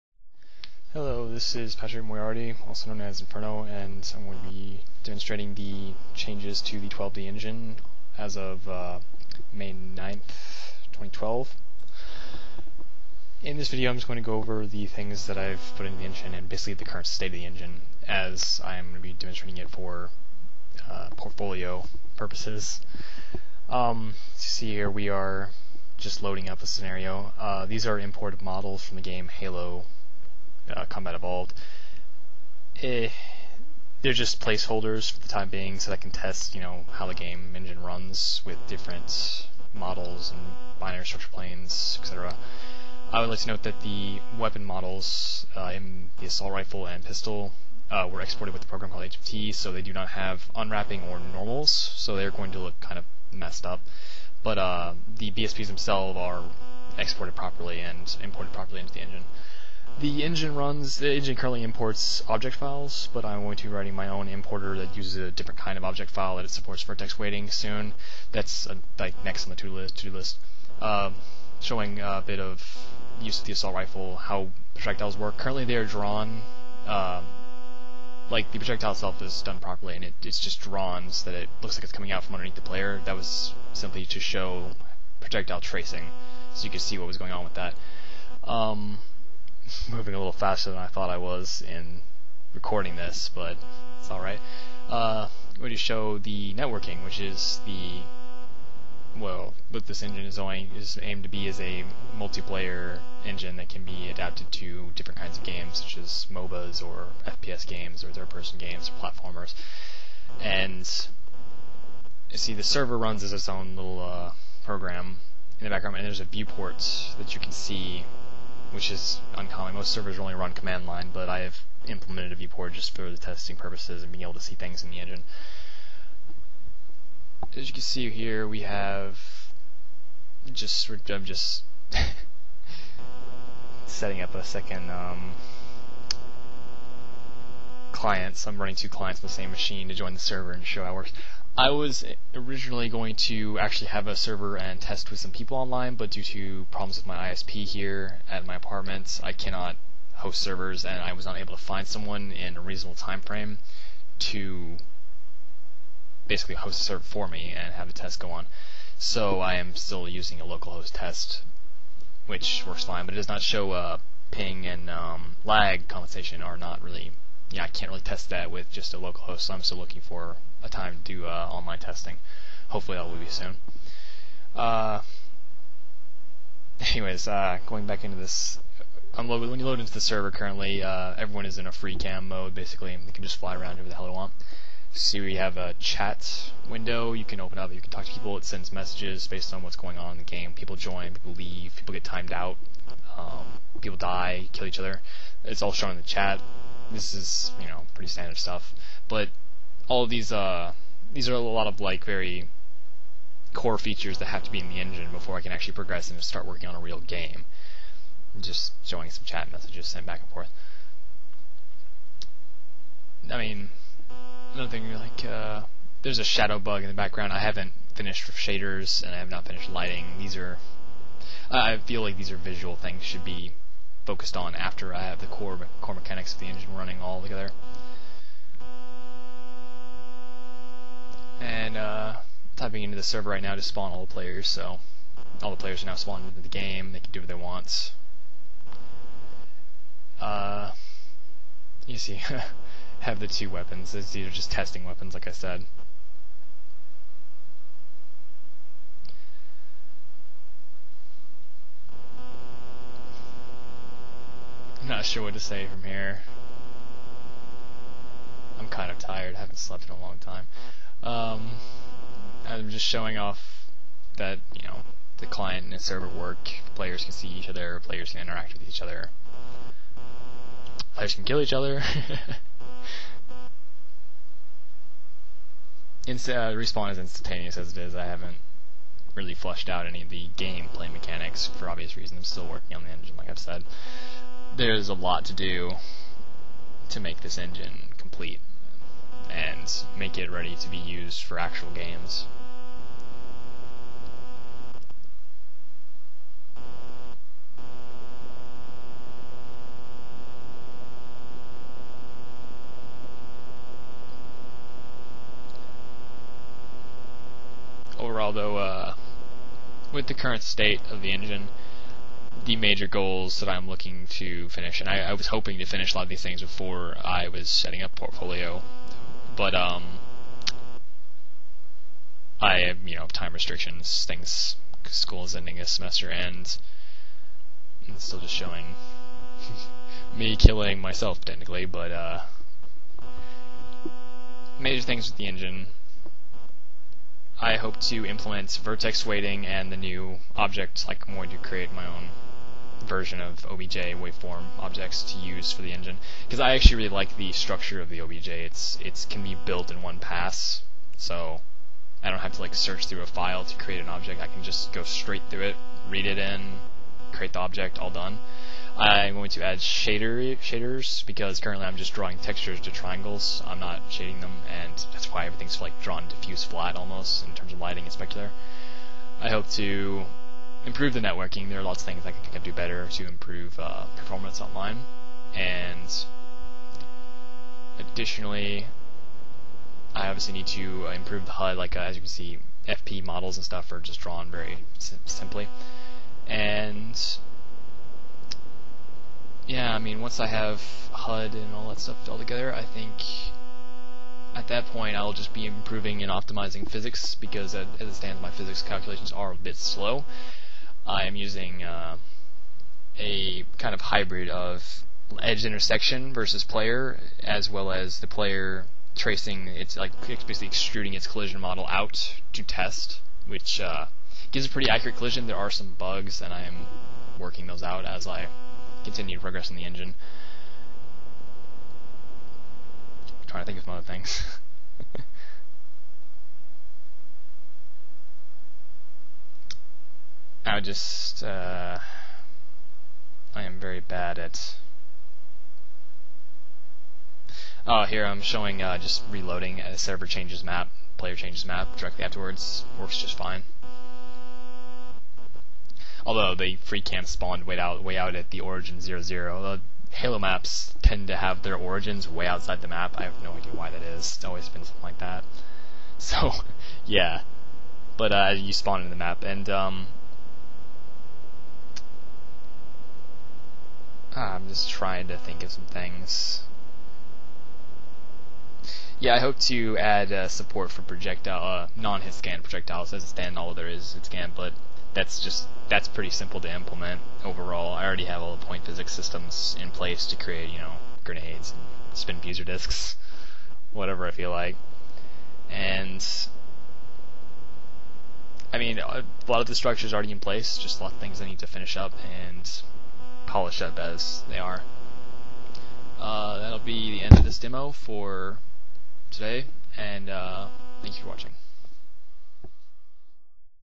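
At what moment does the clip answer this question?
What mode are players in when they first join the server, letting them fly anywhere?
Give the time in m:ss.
3:01.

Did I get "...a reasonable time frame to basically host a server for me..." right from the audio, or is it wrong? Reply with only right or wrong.
right.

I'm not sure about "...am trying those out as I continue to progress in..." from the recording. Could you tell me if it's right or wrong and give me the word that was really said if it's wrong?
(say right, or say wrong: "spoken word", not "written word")
wrong: "working", not "trying".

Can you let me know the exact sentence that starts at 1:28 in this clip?
Um, moving a little faster than I thought I was in recording this, but it's alright.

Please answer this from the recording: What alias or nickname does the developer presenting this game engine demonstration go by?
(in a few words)
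Inferno.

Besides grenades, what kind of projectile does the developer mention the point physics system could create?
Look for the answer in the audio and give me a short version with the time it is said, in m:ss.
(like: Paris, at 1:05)
spinfusor discs, at 8:01.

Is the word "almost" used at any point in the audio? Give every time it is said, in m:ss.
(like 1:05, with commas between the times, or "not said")
6:06.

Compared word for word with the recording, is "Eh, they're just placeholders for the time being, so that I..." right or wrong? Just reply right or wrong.
right.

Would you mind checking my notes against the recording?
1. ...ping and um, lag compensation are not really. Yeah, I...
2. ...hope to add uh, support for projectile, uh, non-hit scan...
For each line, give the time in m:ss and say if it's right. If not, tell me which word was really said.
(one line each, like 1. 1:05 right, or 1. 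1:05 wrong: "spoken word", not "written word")
1. 2:44 right
2. 7:49 right.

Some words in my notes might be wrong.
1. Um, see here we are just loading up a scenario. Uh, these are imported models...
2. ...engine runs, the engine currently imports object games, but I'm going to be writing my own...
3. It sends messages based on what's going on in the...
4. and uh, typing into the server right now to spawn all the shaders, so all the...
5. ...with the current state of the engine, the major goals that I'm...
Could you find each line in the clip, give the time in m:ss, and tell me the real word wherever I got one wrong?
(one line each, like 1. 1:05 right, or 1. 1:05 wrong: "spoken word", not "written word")
1. 0:23 right
2. 1:00 wrong: "files", not "games"
3. 3:08 right
4. 3:51 wrong: "players", not "shaders"
5. 5:09 right.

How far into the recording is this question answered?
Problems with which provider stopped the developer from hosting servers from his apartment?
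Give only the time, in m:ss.
2:27.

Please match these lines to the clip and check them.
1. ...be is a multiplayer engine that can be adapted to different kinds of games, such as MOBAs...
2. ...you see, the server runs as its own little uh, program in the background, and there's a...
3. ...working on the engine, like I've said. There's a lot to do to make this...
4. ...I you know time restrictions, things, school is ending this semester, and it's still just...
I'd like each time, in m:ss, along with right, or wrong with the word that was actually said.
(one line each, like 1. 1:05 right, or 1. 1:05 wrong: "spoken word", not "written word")
1. 1:41 right
2. 1:52 right
3. 4:42 right
4. 5:22 right.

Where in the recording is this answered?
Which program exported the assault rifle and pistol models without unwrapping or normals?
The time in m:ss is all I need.
0:49.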